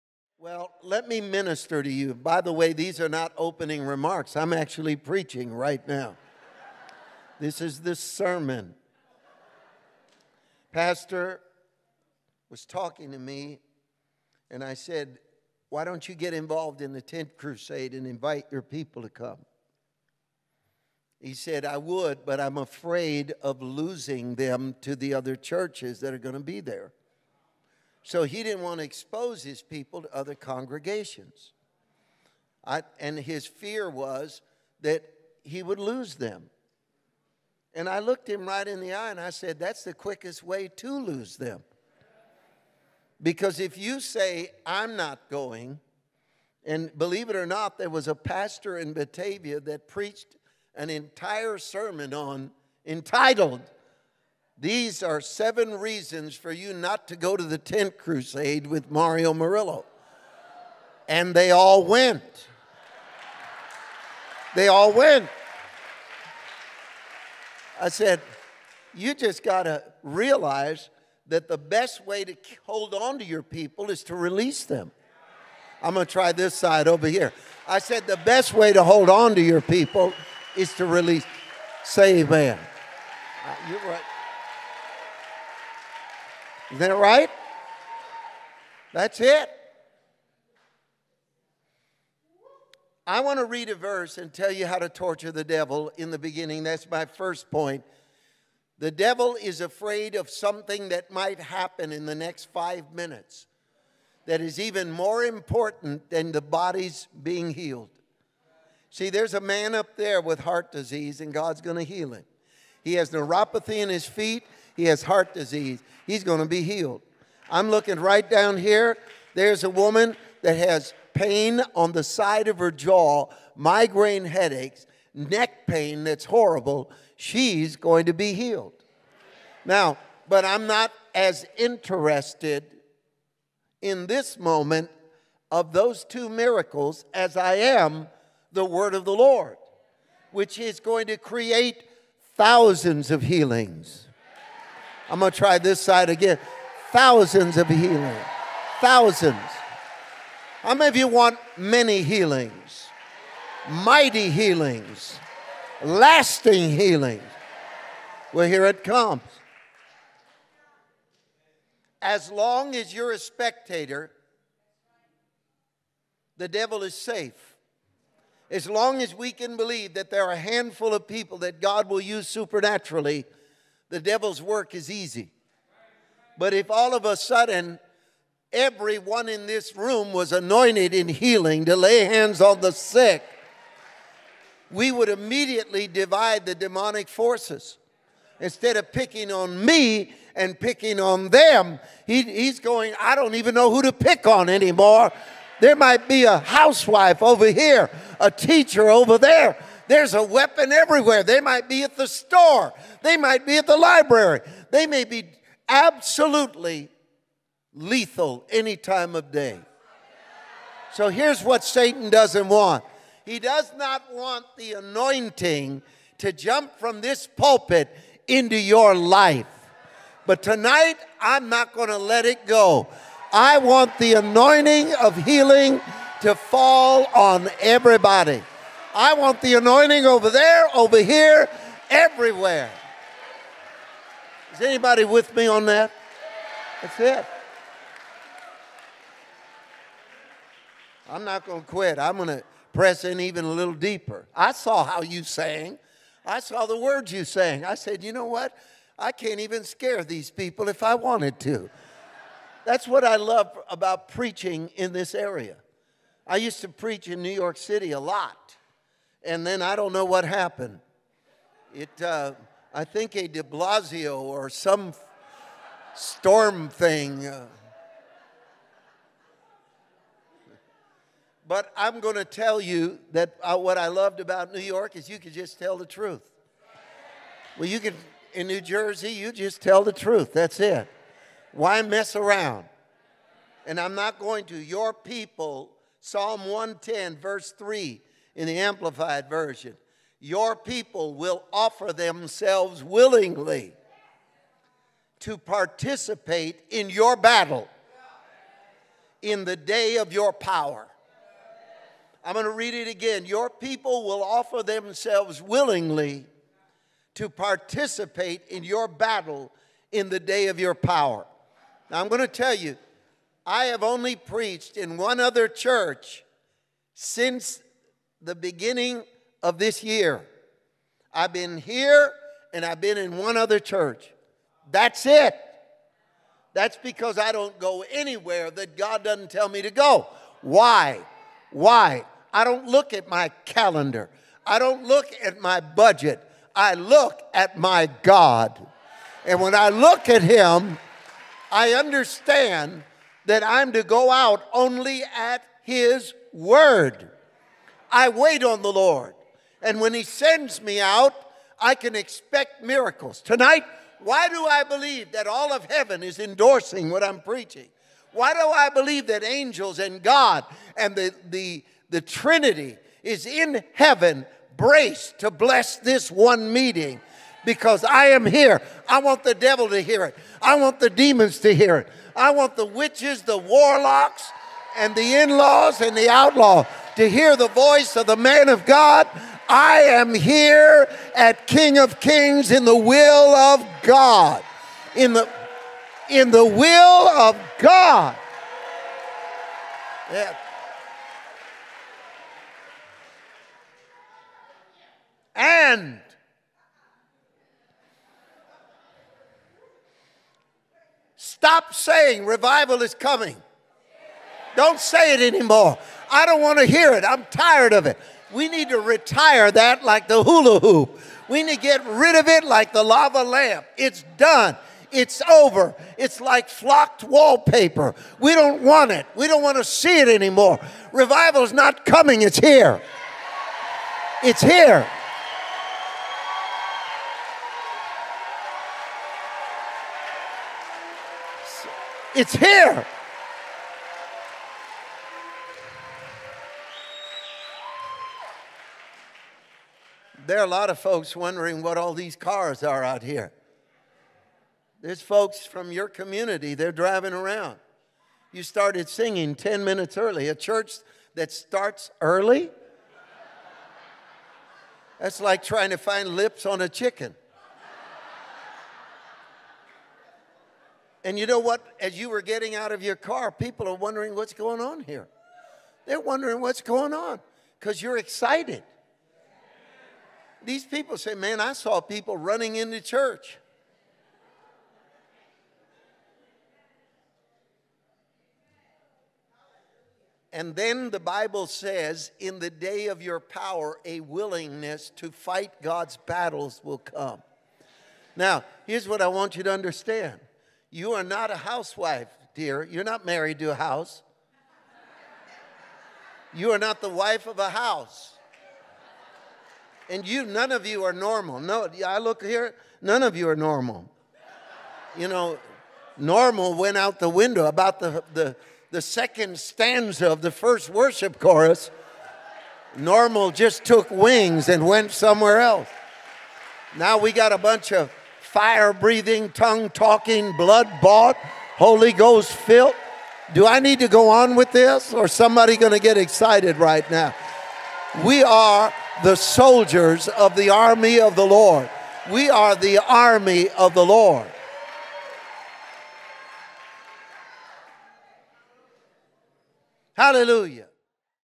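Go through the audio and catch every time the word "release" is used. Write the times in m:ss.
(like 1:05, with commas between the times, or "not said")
1:14, 1:20.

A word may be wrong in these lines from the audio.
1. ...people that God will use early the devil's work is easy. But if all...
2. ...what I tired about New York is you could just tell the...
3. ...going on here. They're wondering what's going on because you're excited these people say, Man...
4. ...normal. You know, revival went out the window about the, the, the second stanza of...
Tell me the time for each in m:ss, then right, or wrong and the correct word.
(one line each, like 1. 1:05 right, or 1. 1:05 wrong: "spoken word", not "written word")
1. 2:51 wrong: "supernaturally", not "early"
2. 4:33 wrong: "loved", not "tired"
3. 7:44 right
4. 8:23 wrong: "normal", not "revival".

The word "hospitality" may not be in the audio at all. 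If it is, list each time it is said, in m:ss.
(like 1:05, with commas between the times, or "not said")
not said.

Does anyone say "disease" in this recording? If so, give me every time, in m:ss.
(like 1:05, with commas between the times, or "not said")
1:50, 1:55.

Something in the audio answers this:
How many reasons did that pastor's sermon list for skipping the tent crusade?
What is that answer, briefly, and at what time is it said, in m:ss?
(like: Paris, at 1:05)
7, at 0:55.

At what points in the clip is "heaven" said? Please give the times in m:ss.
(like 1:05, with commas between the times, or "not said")
5:55, 6:03.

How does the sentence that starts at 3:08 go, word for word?
Instead of picking on me and picking on them, he, he's going, I don't even know who to pick on anymore.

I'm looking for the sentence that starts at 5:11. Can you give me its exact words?
Now, I'm going to tell you, I have only preached in one other church since the beginning of this year.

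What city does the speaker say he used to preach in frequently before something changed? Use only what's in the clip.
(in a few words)
New York City.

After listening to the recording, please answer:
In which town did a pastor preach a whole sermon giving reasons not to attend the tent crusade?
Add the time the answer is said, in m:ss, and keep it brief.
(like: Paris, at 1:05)
Batavia, at 0:48.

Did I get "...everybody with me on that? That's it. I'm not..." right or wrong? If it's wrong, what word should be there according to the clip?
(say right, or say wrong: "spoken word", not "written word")
wrong: "anybody", not "everybody".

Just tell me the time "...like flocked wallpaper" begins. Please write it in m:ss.
6:56.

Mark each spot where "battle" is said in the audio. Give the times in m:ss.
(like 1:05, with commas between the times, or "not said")
4:57, 5:08, 8:05.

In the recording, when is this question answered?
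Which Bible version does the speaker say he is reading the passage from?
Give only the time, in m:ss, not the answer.
4:48.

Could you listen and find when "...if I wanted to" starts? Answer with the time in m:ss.
4:10.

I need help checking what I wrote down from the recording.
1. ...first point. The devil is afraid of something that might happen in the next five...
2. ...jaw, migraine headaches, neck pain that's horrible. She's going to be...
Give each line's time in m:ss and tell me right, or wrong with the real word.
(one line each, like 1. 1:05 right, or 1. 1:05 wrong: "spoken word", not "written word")
1. 1:37 right
2. 2:02 right.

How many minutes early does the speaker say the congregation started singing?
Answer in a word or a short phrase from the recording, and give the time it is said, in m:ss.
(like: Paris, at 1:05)
10, at 7:29.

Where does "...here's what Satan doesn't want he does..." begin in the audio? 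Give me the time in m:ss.
3:31.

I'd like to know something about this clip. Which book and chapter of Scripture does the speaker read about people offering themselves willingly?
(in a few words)
Psalm 110.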